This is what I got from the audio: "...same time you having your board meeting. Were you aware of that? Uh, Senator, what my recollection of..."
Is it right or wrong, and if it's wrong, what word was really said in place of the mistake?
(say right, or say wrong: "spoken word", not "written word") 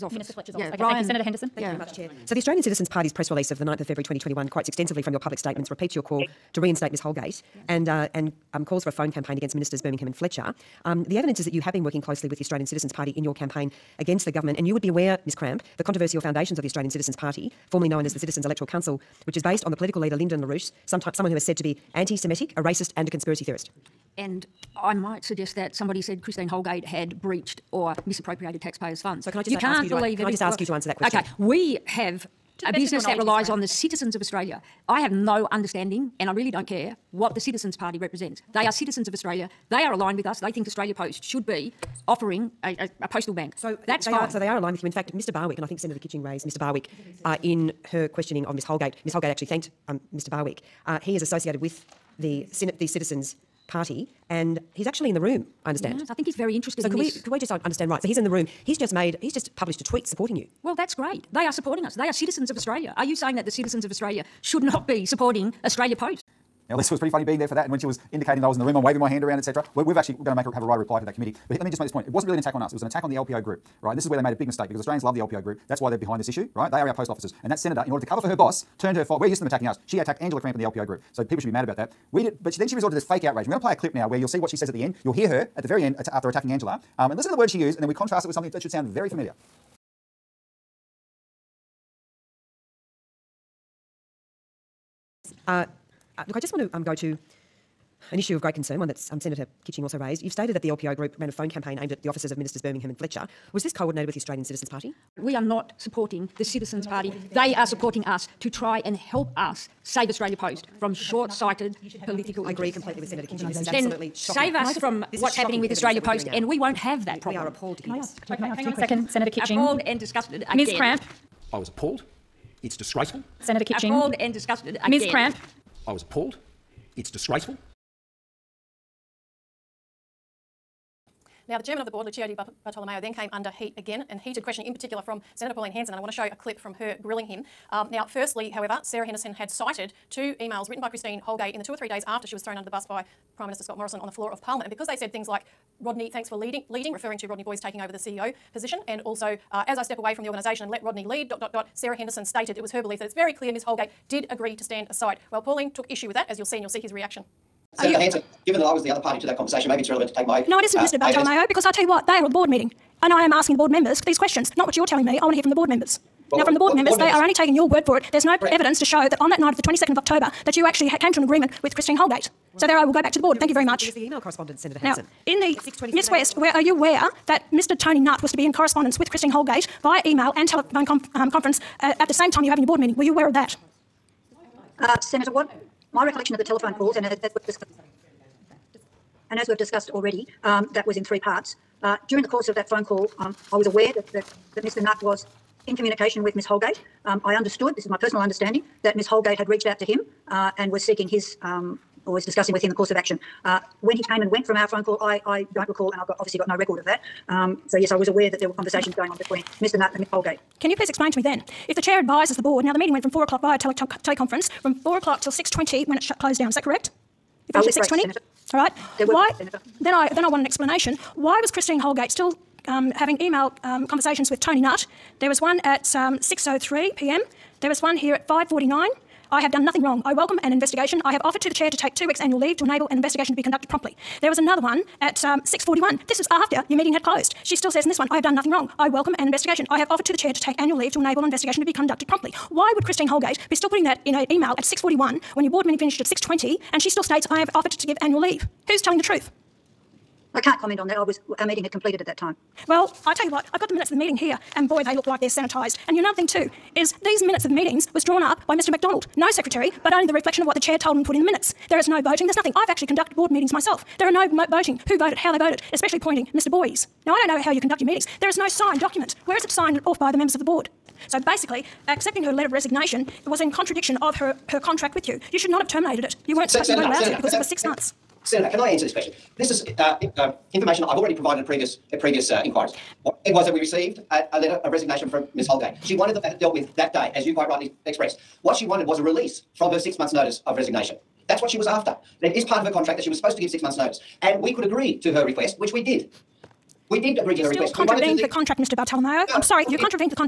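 right.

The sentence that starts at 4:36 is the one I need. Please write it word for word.
You weren't, Senator, you weren't allowed Senator, to because Senator, it was six months.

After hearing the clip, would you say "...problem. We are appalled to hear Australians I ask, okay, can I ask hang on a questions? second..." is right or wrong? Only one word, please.
wrong.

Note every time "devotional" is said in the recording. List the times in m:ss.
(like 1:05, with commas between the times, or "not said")
not said.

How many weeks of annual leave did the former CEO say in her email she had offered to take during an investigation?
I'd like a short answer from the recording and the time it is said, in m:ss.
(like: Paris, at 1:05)
2 weeks, at 3:51.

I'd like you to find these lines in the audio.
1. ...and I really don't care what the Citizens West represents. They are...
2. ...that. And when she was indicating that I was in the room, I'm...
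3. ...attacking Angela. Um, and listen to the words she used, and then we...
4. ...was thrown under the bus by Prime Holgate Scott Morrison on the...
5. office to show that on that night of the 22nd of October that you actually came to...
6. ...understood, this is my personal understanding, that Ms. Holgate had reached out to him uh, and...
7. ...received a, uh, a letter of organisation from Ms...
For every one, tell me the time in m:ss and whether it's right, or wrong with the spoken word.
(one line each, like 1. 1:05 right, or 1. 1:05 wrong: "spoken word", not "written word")
1. 0:36 wrong: "Party", not "West"
2. 1:07 right
3. 1:26 right
4. 2:22 wrong: "Minister", not "Holgate"
5. 2:48 wrong: "evidence", not "office"
6. 3:17 right
7. 4:43 wrong: "resignation", not "organisation".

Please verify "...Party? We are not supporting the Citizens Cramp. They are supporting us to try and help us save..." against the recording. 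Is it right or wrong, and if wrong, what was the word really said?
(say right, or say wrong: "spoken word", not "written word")
wrong: "Party", not "Cramp".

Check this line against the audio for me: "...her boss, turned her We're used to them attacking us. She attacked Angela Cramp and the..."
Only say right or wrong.
right.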